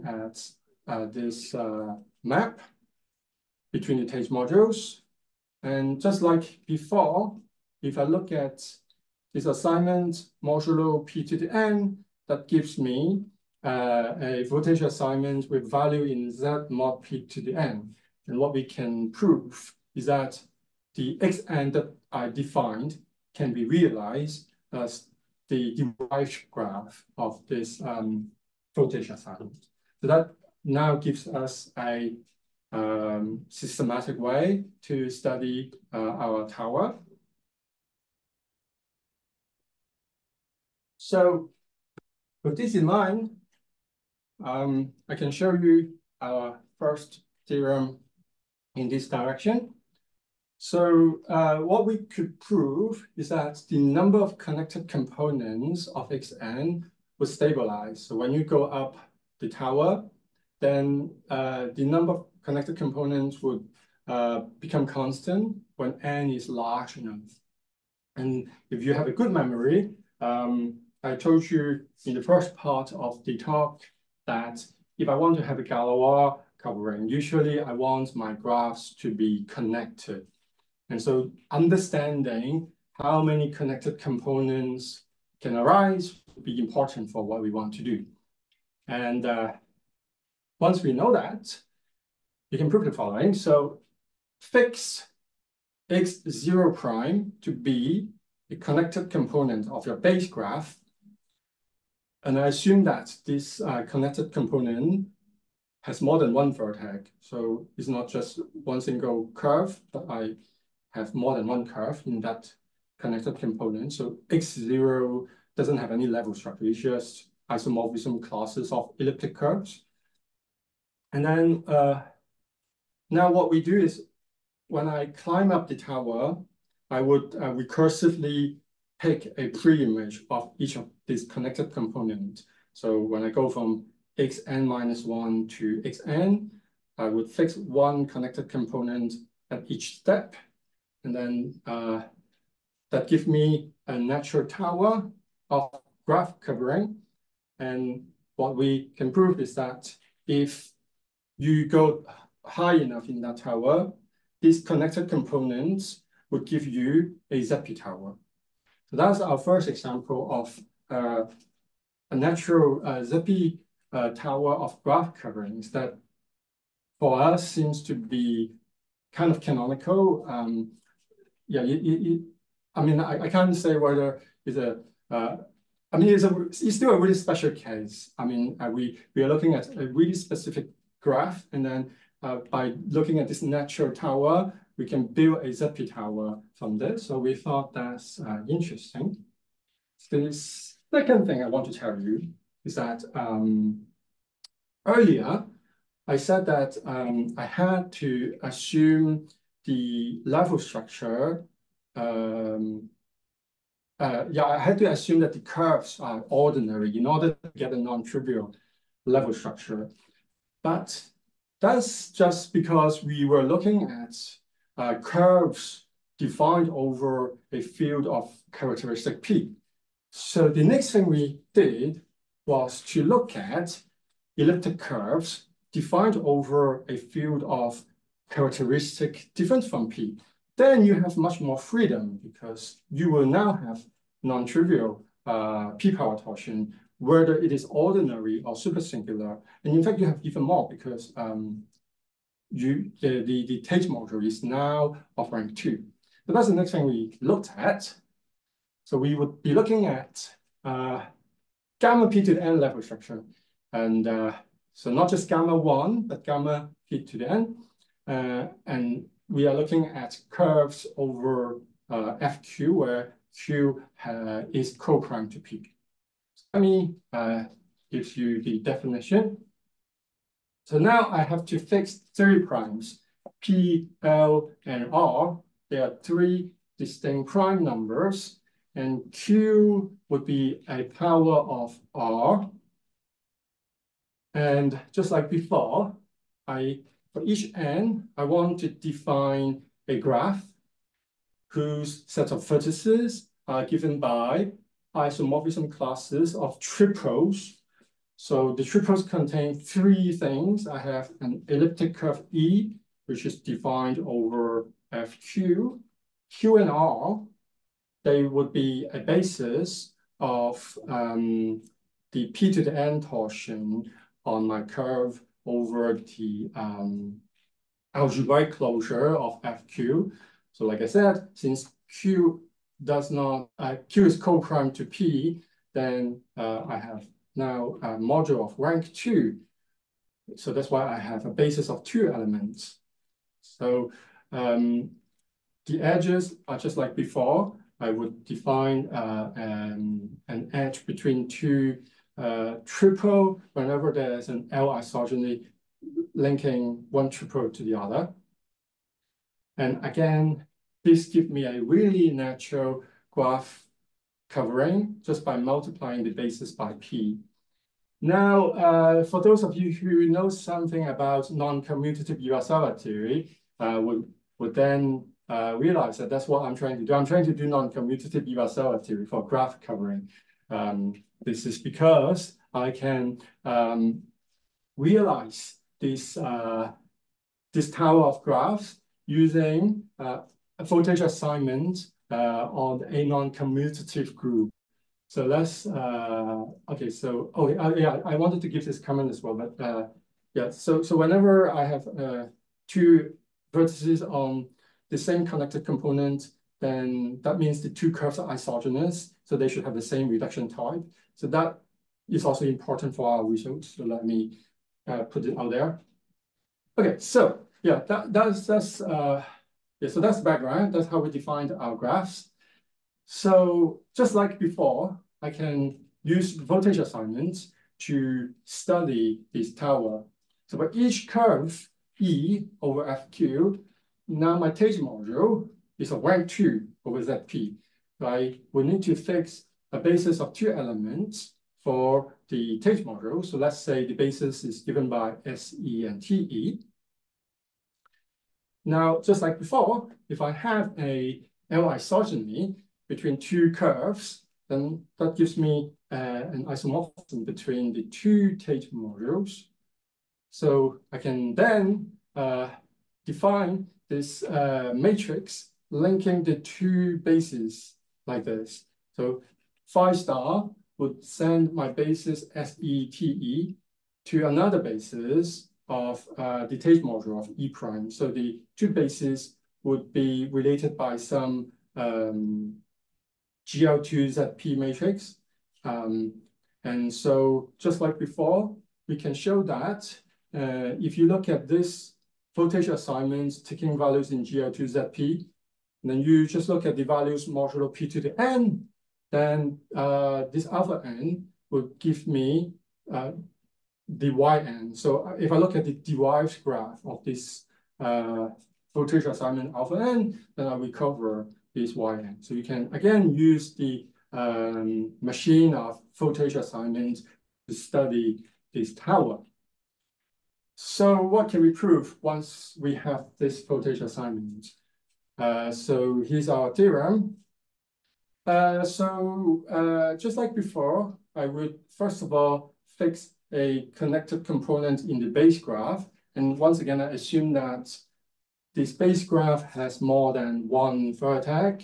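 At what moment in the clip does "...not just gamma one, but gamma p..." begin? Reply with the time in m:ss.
4:14.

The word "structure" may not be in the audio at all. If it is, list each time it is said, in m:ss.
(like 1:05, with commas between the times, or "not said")
1:56, 3:20, 3:29, 4:12.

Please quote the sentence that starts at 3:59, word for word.
And in fact, you have even more because um, you the, the, the Tate module is now of rank two.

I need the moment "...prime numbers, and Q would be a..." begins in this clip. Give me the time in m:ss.
4:37.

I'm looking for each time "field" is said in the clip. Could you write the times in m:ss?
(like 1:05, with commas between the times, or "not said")
3:37, 3:46.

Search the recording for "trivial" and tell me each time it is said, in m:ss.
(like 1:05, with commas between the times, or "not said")
3:27, 3:54.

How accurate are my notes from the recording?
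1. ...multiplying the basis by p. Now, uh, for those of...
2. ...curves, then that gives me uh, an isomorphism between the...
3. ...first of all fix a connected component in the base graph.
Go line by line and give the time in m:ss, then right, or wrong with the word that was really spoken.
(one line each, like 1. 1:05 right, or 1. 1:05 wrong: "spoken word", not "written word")
1. 5:55 right
2. 7:23 right
3. 8:41 right.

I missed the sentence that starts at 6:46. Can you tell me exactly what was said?
Okay, so yeah, that, that's that's uh, yeah, so that's background.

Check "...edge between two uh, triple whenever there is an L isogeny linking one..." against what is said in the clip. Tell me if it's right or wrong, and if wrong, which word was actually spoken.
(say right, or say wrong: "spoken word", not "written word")
right.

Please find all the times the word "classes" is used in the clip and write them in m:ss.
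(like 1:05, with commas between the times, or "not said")
1:58, 4:55.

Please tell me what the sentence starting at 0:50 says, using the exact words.
So uh, what we could prove is that the number of connected components of Xn would stabilize.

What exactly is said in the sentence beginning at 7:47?
So the two bases would be related by some um, GL2ZP matrix.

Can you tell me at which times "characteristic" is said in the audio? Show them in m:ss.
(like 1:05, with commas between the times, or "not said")
3:38, 3:48.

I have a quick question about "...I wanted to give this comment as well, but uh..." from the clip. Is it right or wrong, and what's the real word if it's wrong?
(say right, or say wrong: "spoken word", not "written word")
right.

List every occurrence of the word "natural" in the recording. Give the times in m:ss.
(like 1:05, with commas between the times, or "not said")
2:23, 2:42, 3:03, 5:52.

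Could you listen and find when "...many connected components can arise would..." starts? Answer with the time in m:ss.
1:23.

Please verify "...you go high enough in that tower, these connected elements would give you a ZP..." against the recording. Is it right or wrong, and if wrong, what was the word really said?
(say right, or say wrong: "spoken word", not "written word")
wrong: "components", not "elements".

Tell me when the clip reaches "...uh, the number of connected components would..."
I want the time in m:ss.
1:01.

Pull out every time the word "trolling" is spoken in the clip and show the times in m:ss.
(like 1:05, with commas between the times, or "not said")
not said.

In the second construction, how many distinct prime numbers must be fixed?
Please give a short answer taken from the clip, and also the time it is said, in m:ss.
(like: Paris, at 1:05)
3, at 4:32.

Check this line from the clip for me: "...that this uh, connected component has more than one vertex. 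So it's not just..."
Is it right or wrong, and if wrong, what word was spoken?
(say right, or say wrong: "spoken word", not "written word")
right.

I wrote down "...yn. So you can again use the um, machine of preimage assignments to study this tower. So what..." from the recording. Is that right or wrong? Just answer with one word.
wrong.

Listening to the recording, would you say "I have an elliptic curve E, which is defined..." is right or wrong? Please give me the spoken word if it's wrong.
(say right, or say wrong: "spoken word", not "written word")
right.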